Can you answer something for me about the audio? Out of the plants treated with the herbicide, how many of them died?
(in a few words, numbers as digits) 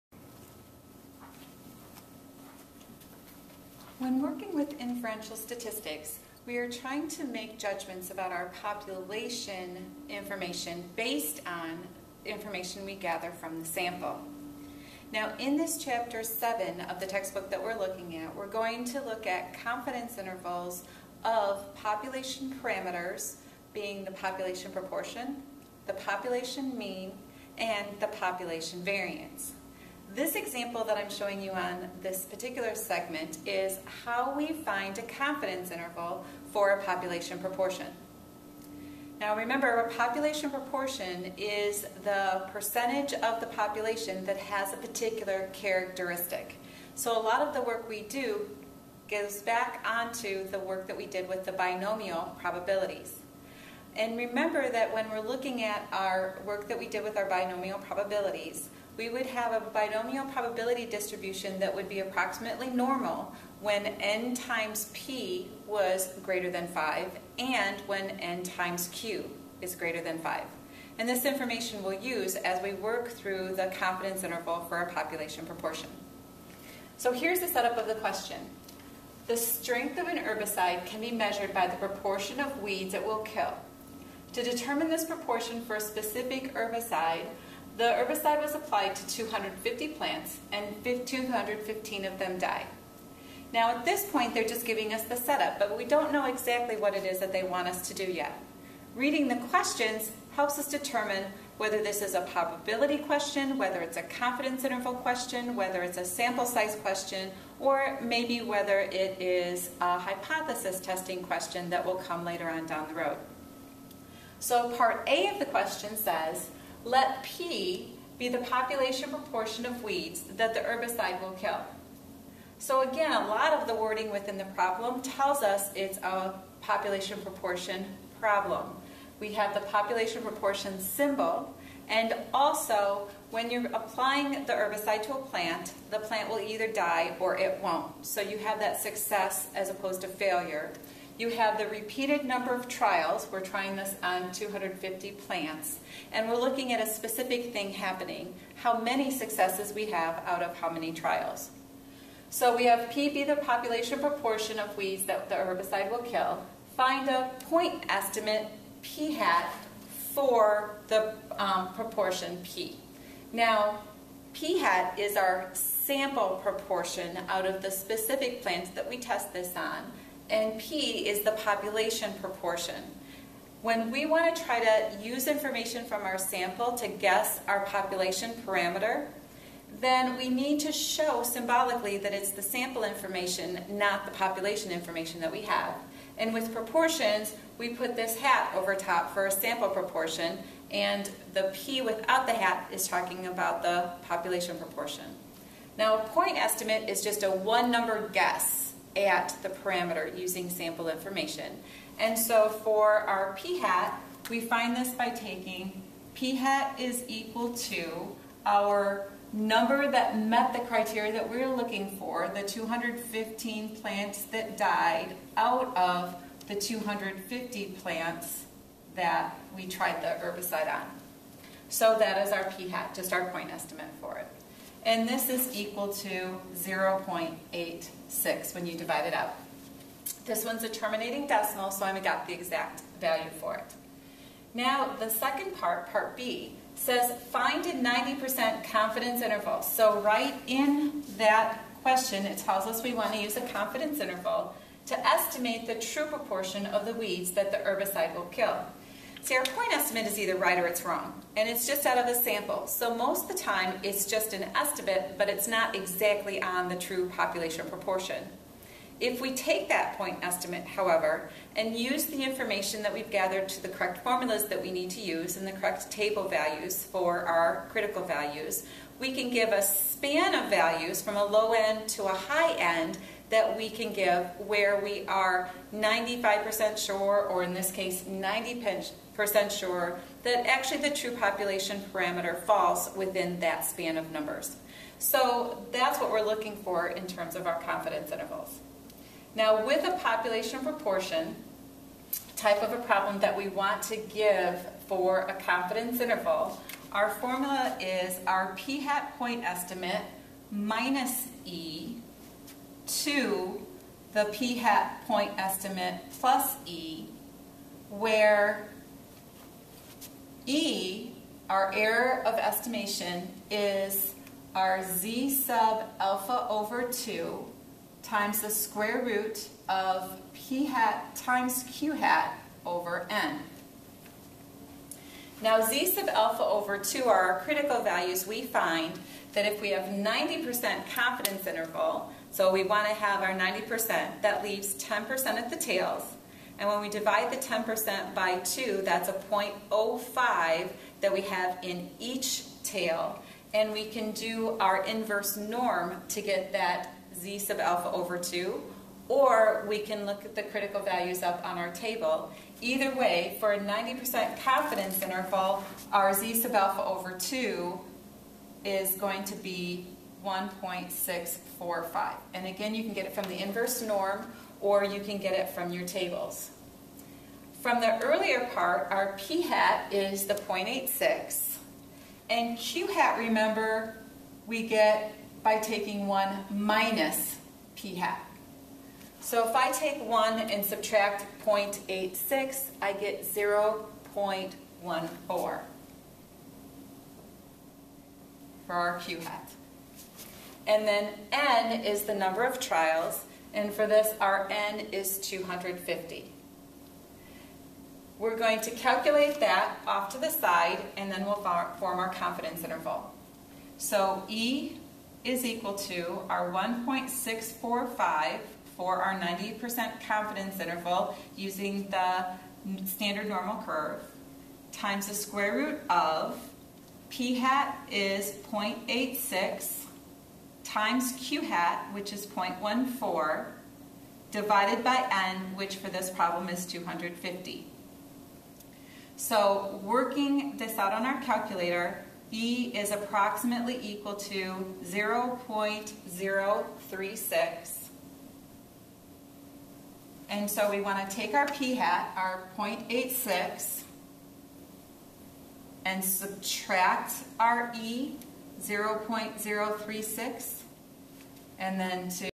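215.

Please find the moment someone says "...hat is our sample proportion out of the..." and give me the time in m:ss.
2:44.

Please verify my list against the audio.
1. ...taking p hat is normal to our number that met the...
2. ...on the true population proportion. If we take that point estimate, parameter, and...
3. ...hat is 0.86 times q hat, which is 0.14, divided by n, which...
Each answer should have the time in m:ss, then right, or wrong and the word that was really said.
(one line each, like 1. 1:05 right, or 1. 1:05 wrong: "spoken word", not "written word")
1. 3:25 wrong: "equal", not "normal"
2. 4:16 wrong: "however", not "parameter"
3. 6:57 right.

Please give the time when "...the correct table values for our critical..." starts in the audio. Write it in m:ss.
4:25.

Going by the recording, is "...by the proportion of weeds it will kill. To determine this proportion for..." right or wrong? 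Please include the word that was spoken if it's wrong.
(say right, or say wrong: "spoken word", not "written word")
right.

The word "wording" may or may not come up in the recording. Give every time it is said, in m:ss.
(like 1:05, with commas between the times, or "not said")
2:03.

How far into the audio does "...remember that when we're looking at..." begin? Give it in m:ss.
0:54.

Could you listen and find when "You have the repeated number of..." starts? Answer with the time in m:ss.
2:21.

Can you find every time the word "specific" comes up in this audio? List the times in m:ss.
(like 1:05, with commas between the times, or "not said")
1:25, 2:26, 2:47.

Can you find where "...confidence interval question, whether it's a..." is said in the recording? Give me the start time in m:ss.
1:44.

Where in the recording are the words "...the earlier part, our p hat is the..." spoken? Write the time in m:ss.
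6:07.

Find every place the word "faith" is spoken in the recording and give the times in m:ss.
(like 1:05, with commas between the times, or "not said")
not said.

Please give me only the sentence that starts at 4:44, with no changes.
So that's what we're looking for in terms of our confidence intervals.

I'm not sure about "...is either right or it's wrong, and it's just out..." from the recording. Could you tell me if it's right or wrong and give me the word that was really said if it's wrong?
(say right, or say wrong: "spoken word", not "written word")
right.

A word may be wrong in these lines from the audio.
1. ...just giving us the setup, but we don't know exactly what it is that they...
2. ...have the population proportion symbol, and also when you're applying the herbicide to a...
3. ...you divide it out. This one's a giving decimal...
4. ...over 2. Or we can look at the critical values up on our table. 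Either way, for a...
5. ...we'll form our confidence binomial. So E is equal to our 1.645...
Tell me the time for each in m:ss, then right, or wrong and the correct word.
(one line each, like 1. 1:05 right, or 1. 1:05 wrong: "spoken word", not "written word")
1. 1:34 right
2. 2:09 right
3. 3:48 wrong: "terminating", not "giving"
4. 5:47 right
5. 6:41 wrong: "interval", not "binomial".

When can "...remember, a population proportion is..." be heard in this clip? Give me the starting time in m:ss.
0:39.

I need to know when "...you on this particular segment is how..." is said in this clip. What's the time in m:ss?
0:31.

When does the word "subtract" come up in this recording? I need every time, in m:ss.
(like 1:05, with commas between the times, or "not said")
6:20, 7:26.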